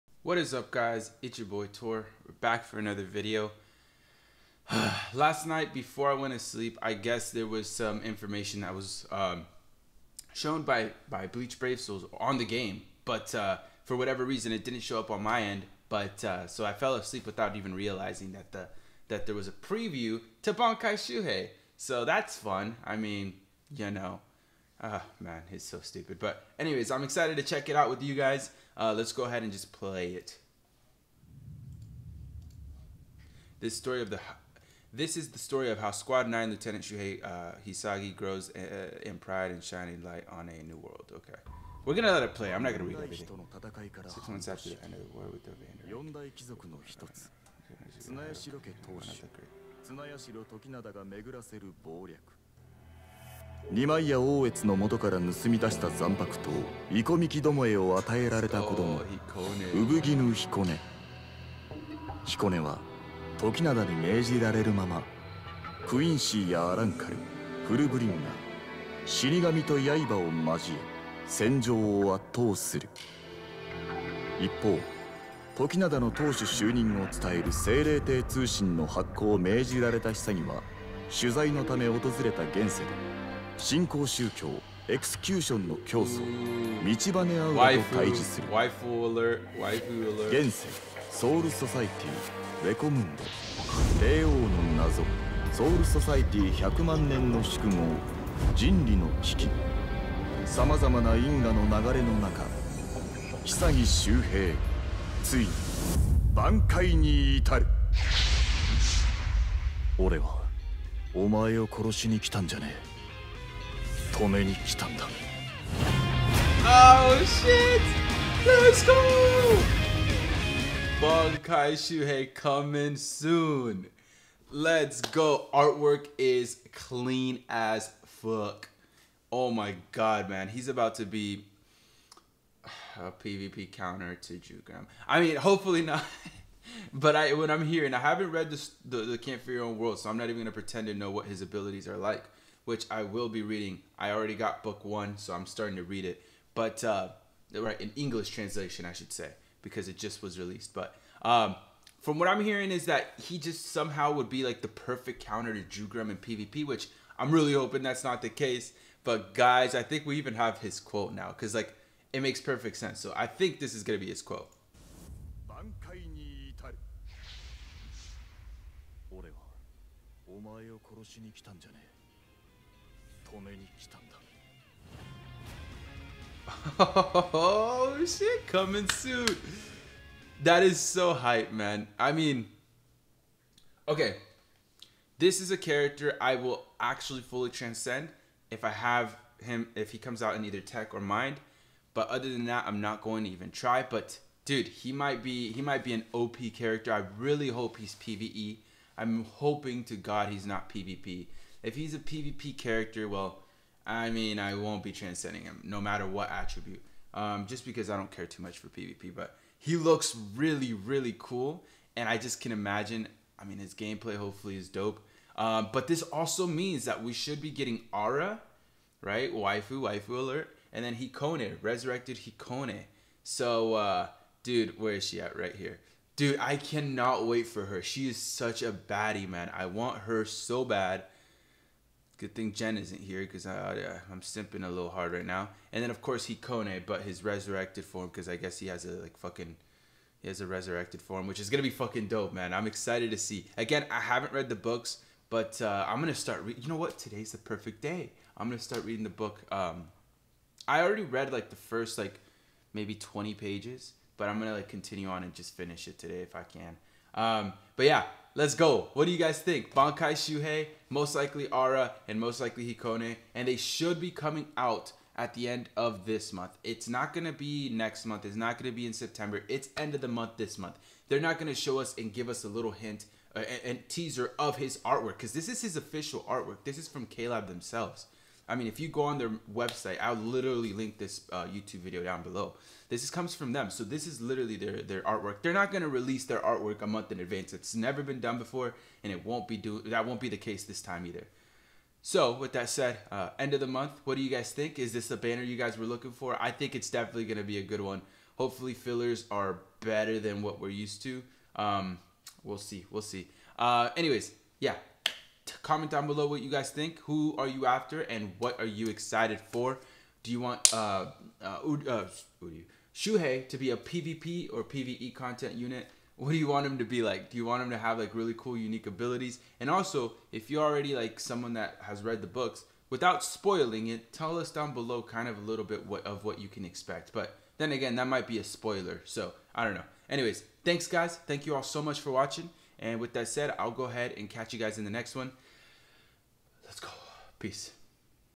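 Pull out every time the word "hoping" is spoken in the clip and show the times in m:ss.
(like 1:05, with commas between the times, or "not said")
2:37, 3:19.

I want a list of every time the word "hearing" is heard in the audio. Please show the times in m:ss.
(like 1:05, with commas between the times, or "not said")
2:17, 2:32.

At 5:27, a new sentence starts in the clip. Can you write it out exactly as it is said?
But then again, that might be a spoiler, so I don't know.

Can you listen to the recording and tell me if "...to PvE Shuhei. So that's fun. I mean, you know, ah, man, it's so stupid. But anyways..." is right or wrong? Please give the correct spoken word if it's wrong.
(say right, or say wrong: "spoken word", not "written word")
wrong: "Bankai", not "PvE".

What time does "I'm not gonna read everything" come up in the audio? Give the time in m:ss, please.
0:42.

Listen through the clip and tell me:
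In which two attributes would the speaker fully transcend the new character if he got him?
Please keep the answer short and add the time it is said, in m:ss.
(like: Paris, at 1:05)
Tech or Mind, at 3:10.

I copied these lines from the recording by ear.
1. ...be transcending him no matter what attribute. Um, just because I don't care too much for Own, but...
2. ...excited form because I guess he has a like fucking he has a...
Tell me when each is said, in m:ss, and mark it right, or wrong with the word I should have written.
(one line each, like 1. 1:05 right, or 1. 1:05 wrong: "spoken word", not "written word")
1. 3:24 wrong: "PvP", not "Own"
2. 3:57 wrong: "resurrected", not "excited".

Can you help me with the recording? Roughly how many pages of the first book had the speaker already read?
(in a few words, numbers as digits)
20.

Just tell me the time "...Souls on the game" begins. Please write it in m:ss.
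0:11.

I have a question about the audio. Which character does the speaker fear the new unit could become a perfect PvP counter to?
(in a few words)
Jugram.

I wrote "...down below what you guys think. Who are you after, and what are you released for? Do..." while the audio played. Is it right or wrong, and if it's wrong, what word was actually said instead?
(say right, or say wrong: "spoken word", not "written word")
wrong: "excited", not "released".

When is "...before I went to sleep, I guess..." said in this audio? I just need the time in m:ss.
0:05.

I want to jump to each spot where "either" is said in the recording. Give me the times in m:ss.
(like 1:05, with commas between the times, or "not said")
3:10, 4:51.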